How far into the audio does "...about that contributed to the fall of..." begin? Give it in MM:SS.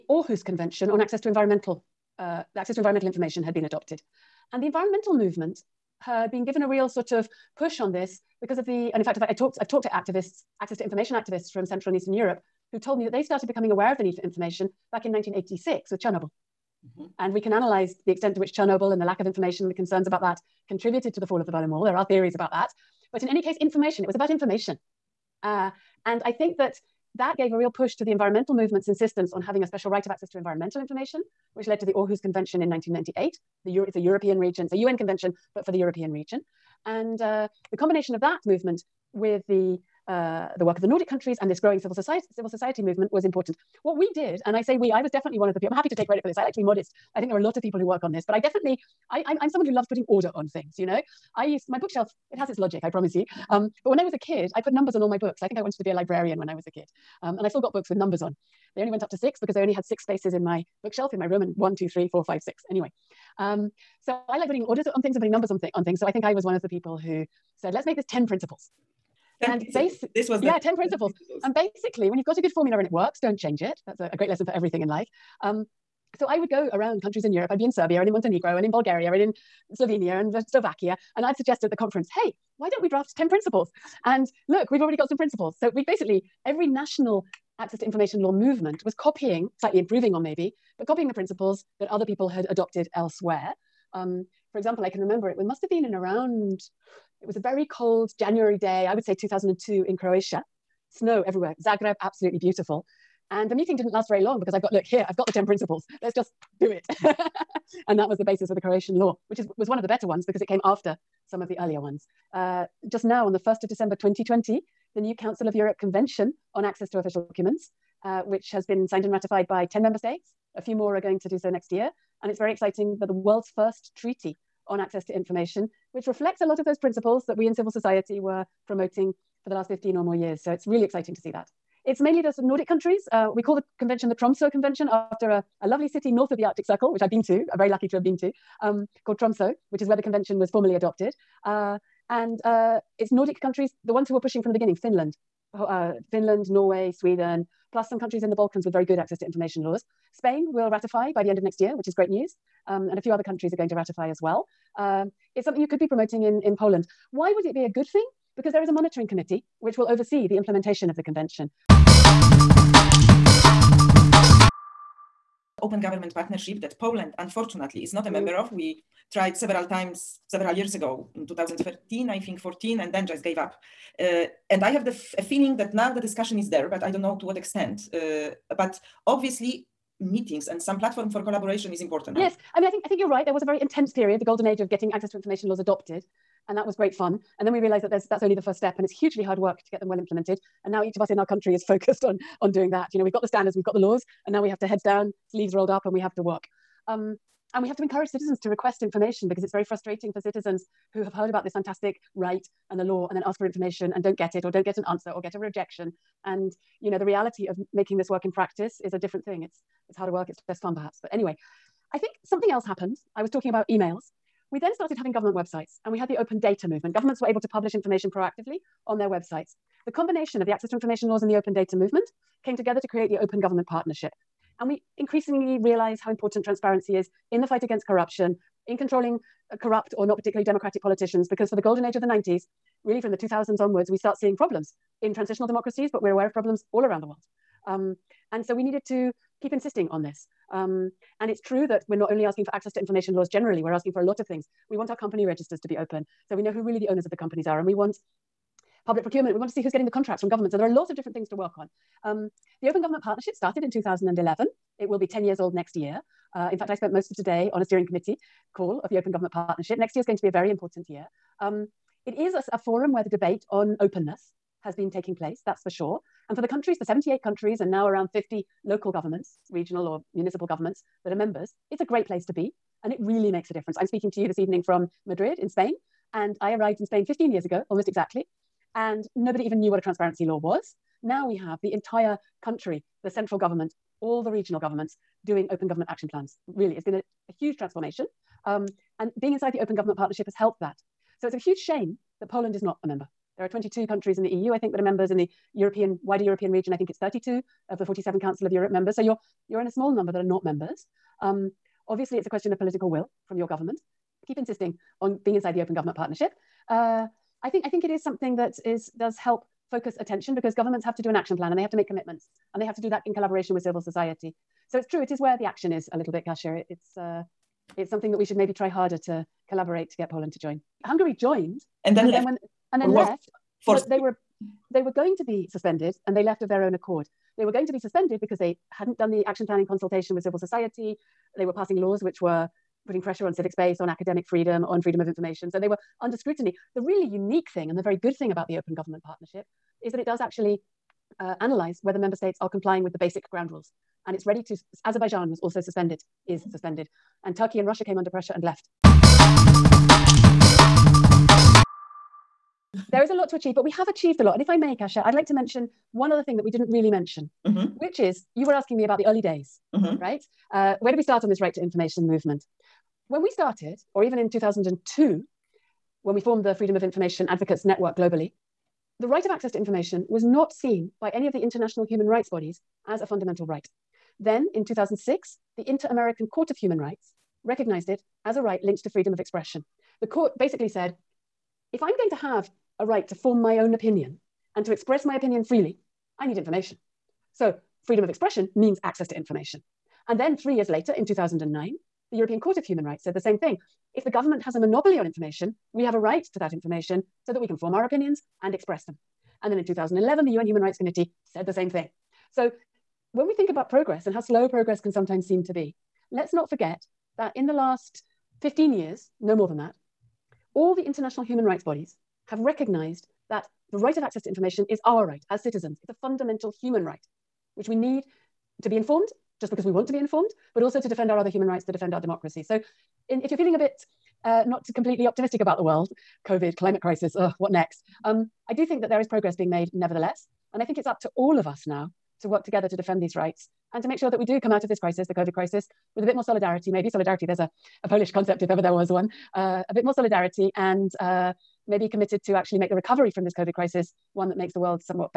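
00:20.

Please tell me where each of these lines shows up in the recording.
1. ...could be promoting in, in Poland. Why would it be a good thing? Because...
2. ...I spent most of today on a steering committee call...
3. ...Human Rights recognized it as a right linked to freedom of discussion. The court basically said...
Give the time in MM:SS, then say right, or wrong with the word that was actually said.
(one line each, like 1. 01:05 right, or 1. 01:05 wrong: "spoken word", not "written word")
1. 02:35 right
2. 04:16 right
3. 06:16 wrong: "expression", not "discussion".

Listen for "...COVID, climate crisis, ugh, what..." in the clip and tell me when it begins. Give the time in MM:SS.
07:06.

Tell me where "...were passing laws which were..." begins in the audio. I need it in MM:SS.
05:31.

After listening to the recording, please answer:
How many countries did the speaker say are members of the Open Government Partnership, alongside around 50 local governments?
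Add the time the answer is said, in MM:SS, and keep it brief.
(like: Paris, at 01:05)
78, at 04:26.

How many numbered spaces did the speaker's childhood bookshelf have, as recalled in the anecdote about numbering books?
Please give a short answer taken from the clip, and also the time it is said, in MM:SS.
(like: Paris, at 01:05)
6, at 00:59.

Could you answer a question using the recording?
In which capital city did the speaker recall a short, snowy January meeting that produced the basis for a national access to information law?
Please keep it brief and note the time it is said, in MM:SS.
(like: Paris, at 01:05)
Zagreb, at 01:41.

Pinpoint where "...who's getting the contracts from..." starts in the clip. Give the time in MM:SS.
04:09.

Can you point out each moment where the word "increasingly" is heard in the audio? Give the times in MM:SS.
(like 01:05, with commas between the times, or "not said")
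03:44.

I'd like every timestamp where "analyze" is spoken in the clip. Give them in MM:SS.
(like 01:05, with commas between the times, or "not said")
00:17, 05:41.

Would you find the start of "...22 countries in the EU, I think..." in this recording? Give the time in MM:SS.
04:53.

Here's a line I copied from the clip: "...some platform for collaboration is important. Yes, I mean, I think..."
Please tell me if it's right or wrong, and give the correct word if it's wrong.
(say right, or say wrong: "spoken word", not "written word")
right.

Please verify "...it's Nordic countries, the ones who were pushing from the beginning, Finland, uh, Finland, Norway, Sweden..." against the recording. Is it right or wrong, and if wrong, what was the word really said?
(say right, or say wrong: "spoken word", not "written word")
right.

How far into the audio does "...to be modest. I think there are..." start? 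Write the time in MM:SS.
00:46.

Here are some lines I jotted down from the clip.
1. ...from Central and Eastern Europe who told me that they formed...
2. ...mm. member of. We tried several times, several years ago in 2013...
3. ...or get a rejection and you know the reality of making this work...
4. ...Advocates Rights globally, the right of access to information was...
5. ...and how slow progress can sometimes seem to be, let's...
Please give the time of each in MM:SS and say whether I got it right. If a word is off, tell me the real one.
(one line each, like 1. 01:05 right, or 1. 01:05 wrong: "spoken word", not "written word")
1. 00:11 wrong: "started", not "formed"
2. 02:48 right
3. 03:25 right
4. 06:07 wrong: "Network", not "Rights"
5. 06:44 right.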